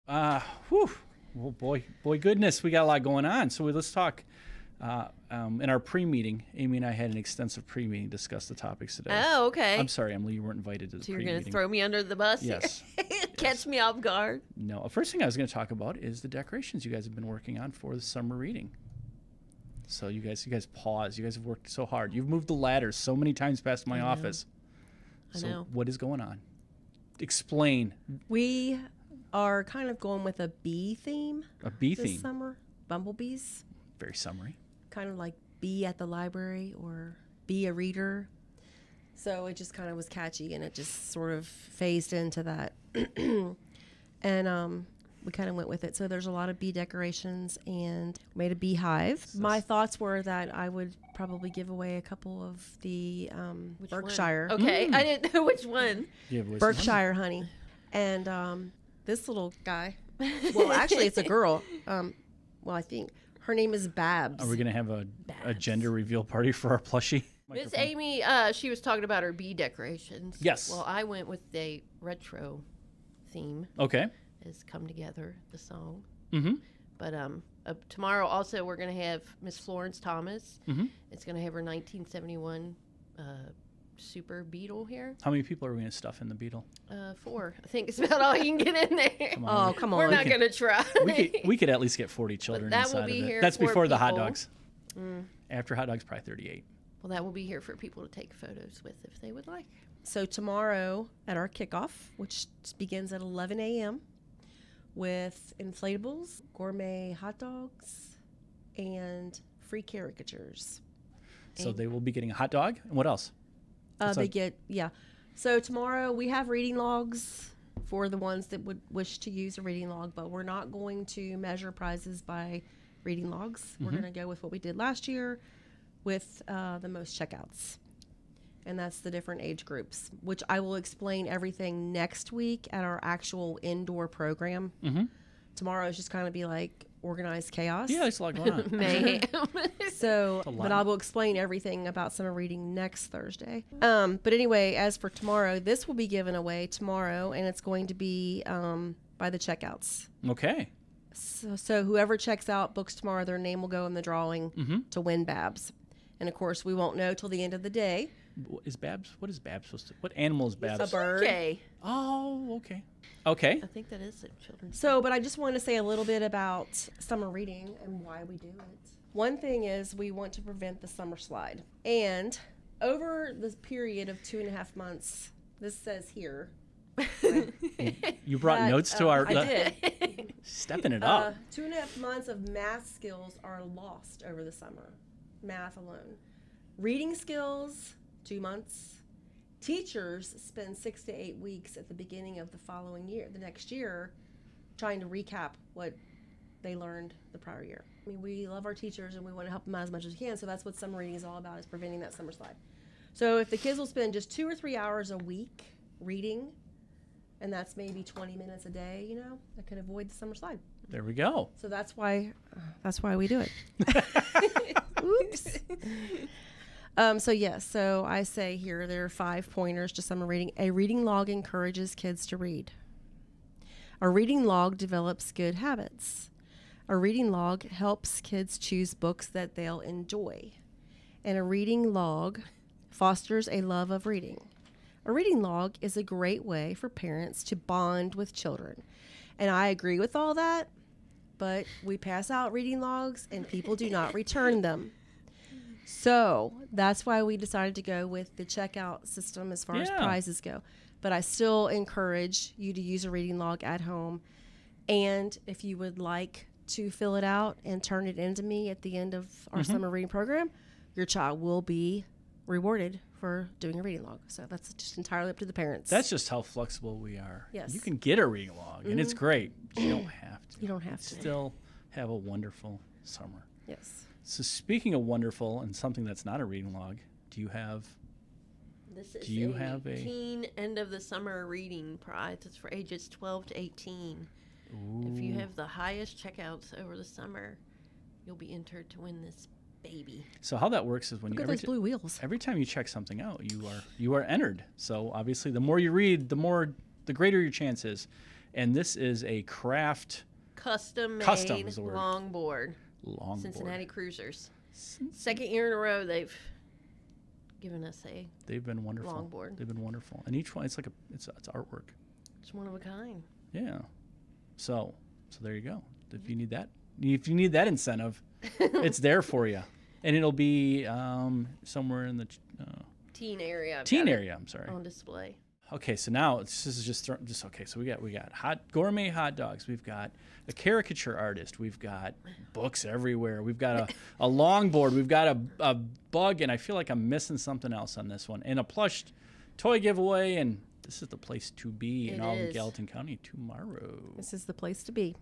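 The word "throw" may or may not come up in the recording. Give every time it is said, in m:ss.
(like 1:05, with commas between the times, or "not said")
0:11, 5:27.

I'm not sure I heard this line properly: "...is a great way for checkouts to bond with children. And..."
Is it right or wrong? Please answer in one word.
wrong.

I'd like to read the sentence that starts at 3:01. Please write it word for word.
Uh, two and a half months of math skills are lost over the summer, math alone.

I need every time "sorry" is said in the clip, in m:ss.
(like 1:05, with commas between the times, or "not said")
0:09, 5:24.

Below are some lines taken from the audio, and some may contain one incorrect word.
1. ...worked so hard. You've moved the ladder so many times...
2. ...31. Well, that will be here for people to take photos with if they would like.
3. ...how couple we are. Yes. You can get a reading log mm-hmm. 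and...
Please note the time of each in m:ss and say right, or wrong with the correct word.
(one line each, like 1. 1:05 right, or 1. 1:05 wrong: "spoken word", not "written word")
1. 0:21 right
2. 1:36 wrong: "38", not "31"
3. 4:26 wrong: "flexible", not "couple".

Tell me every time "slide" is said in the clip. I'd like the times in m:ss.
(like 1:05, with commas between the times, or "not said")
2:51, 3:22, 3:30.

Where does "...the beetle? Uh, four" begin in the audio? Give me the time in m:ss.
1:26.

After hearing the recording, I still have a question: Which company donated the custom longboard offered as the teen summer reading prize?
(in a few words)
Cincinnati Cruisers.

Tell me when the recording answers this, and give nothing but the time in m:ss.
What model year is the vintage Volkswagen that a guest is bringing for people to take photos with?
1:21.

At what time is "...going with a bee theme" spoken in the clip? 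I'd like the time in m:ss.
0:29.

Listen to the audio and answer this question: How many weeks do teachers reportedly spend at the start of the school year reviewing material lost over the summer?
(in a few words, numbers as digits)
6 to 8 weeks.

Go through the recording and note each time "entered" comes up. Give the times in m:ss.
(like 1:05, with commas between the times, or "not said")
4:48, 4:54.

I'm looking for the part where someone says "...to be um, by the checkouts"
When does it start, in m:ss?
2:27.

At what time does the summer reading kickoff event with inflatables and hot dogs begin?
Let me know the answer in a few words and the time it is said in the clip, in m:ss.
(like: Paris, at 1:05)
11 a.m., at 1:43.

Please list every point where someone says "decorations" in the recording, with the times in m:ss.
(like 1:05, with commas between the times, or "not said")
0:16, 0:46, 1:09.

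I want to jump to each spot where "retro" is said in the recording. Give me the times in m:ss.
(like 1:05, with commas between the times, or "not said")
1:12.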